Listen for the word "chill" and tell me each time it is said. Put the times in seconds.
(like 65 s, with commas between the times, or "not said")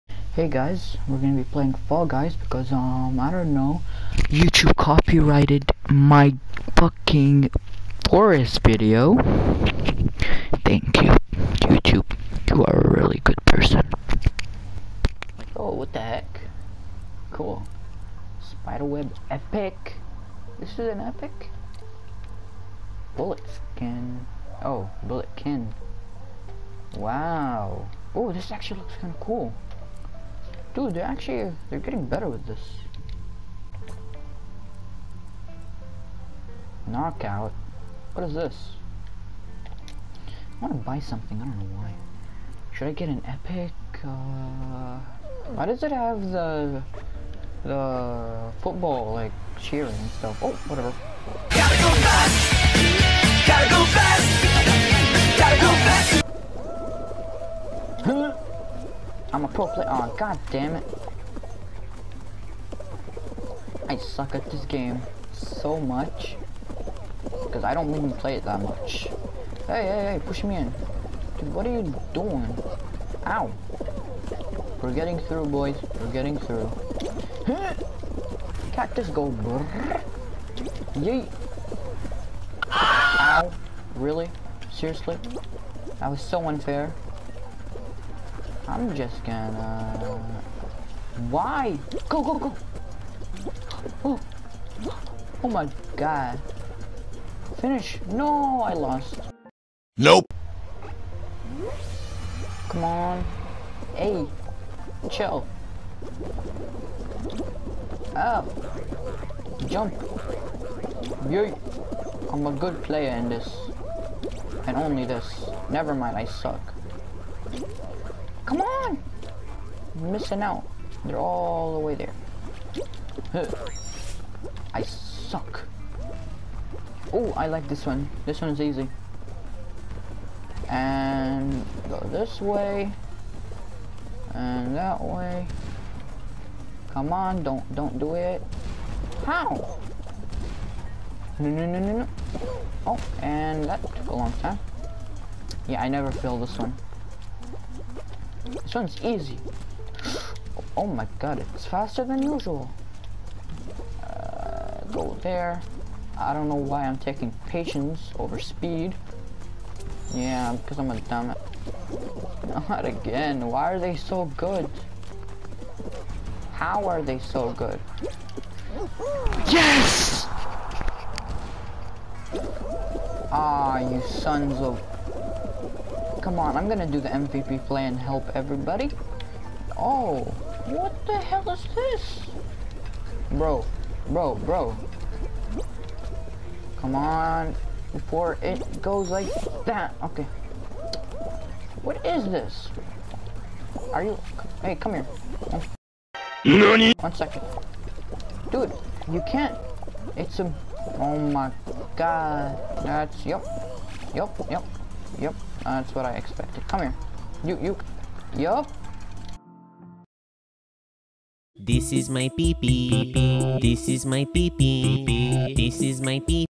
105 s.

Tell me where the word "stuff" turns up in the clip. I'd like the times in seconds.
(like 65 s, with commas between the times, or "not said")
50 s.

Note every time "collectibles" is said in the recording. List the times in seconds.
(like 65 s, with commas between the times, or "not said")
not said.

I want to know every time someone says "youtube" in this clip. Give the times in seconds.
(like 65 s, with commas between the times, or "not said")
4 s, 11 s.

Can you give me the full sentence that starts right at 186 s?
Come on, before it goes like that.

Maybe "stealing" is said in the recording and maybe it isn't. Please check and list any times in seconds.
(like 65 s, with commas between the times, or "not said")
not said.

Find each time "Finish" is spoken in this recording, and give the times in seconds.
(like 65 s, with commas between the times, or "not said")
97 s.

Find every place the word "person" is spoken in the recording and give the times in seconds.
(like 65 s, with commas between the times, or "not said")
13 s.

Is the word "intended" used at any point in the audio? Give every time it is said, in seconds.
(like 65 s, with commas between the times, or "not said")
not said.